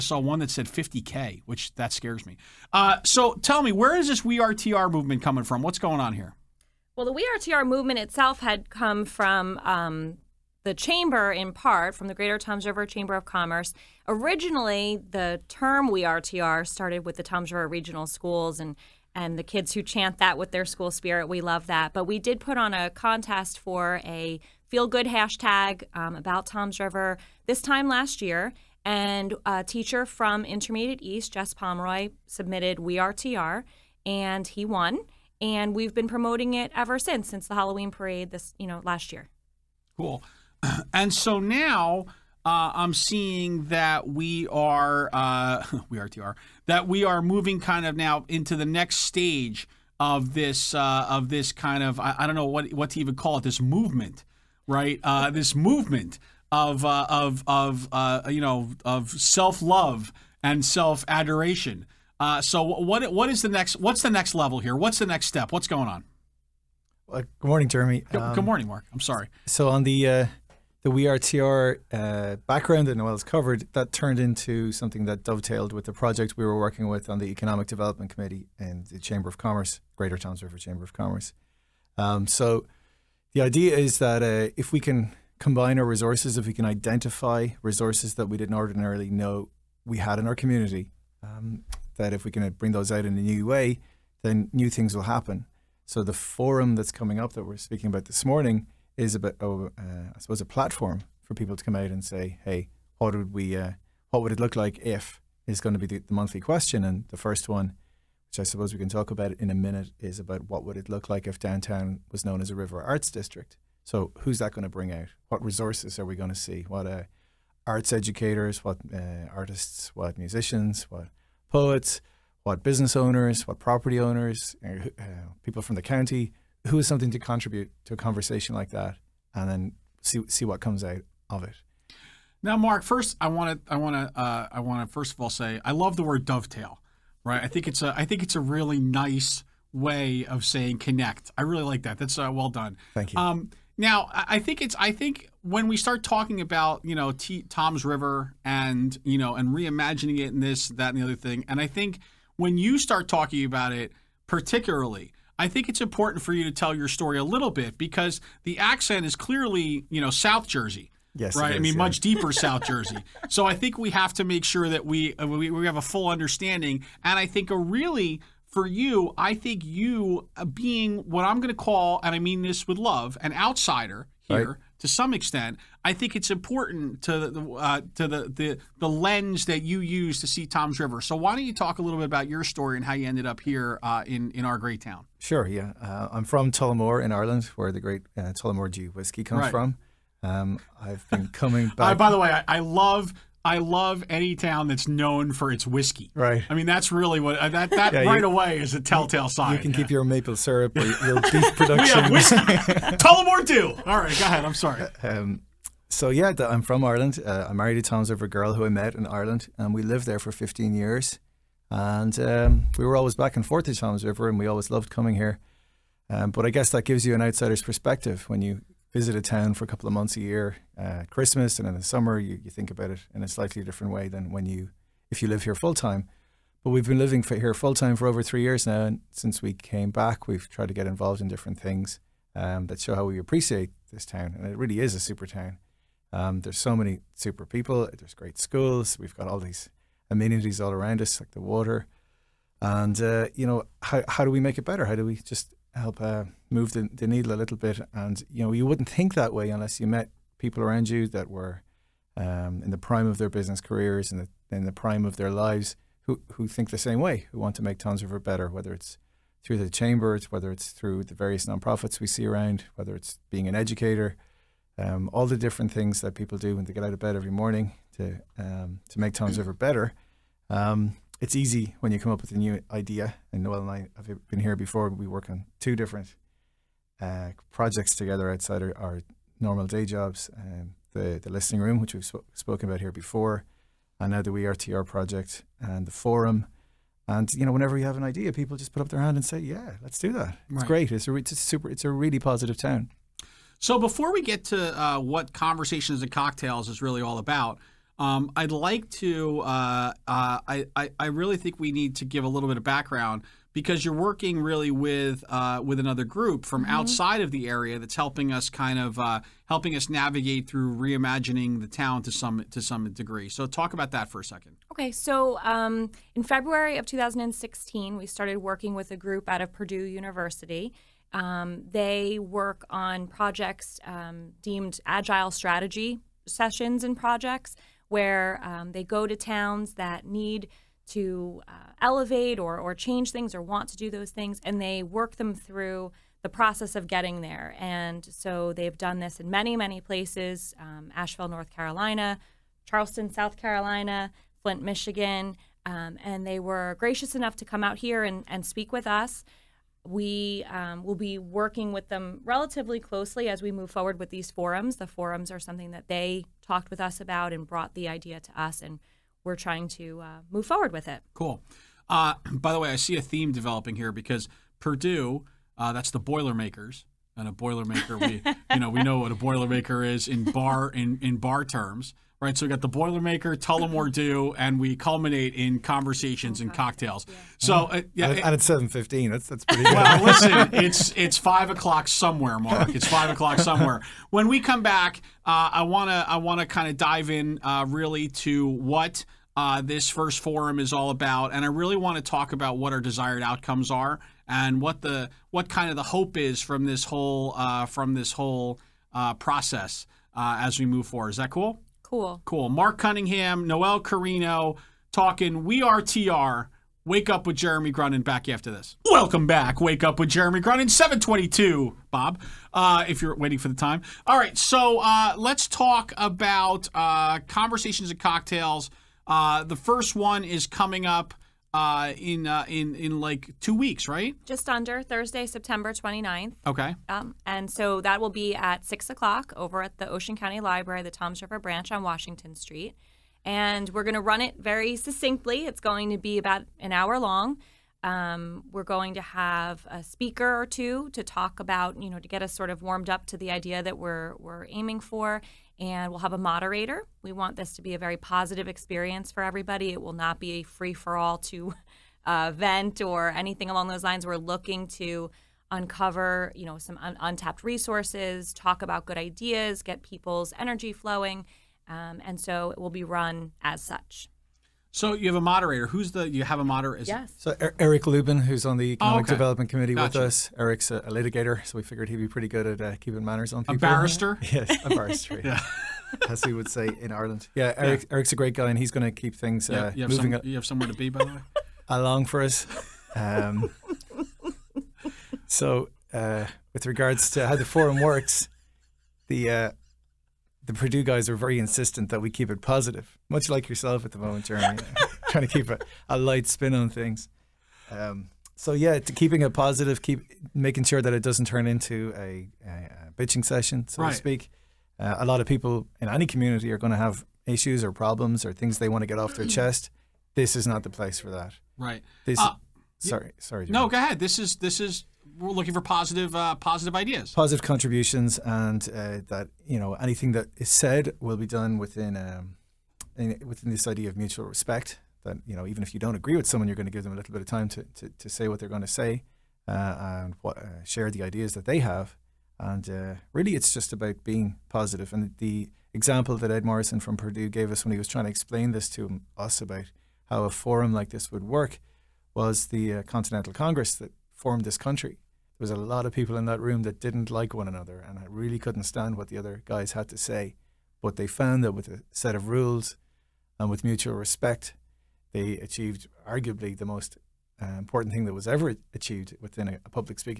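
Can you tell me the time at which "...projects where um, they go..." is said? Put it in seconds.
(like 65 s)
326 s.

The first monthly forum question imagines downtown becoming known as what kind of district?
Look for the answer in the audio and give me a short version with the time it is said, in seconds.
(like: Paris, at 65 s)
river arts district, at 112 s.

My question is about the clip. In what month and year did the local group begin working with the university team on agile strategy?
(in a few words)
February 2016.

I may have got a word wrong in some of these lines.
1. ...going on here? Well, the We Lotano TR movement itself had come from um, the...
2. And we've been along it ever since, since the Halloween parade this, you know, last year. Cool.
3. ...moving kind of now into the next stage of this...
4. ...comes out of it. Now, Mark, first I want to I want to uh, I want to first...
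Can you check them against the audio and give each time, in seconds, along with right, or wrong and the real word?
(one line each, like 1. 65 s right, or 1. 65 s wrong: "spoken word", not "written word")
1. 5 s wrong: "Are", not "Lotano"
2. 35 s wrong: "promoting", not "along"
3. 47 s right
4. 130 s right.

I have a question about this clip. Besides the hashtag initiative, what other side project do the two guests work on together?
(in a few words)
the listening room.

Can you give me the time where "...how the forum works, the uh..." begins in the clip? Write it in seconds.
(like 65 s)
487 s.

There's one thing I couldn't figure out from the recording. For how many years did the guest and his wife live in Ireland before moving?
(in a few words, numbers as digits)
15.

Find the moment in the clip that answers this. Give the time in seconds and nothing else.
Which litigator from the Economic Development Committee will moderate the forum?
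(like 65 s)
467 s.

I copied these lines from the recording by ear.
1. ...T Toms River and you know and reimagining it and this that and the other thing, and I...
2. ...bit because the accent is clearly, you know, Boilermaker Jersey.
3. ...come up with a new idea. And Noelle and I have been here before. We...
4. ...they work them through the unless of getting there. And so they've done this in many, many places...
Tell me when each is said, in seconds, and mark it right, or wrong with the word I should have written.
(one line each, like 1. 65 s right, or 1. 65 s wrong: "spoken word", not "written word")
1. 147 s right
2. 157 s wrong: "South", not "Boilermaker"
3. 271 s right
4. 334 s wrong: "process", not "unless".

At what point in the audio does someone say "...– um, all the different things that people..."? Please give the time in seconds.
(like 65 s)
264 s.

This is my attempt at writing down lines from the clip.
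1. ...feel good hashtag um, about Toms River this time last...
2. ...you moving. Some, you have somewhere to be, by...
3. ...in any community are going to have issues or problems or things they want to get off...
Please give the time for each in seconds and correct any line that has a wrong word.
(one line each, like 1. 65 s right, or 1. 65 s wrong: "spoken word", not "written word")
1. 24 s right
2. 479 s right
3. 505 s right.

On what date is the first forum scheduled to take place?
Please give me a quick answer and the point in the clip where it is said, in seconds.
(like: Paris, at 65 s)
Thursday, September 29th, at 424 s.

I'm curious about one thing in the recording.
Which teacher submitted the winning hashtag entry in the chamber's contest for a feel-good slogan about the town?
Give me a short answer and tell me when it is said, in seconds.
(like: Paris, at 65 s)
Jess Pomeroy, at 31 s.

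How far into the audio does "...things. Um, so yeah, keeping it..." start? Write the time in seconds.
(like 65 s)
496 s.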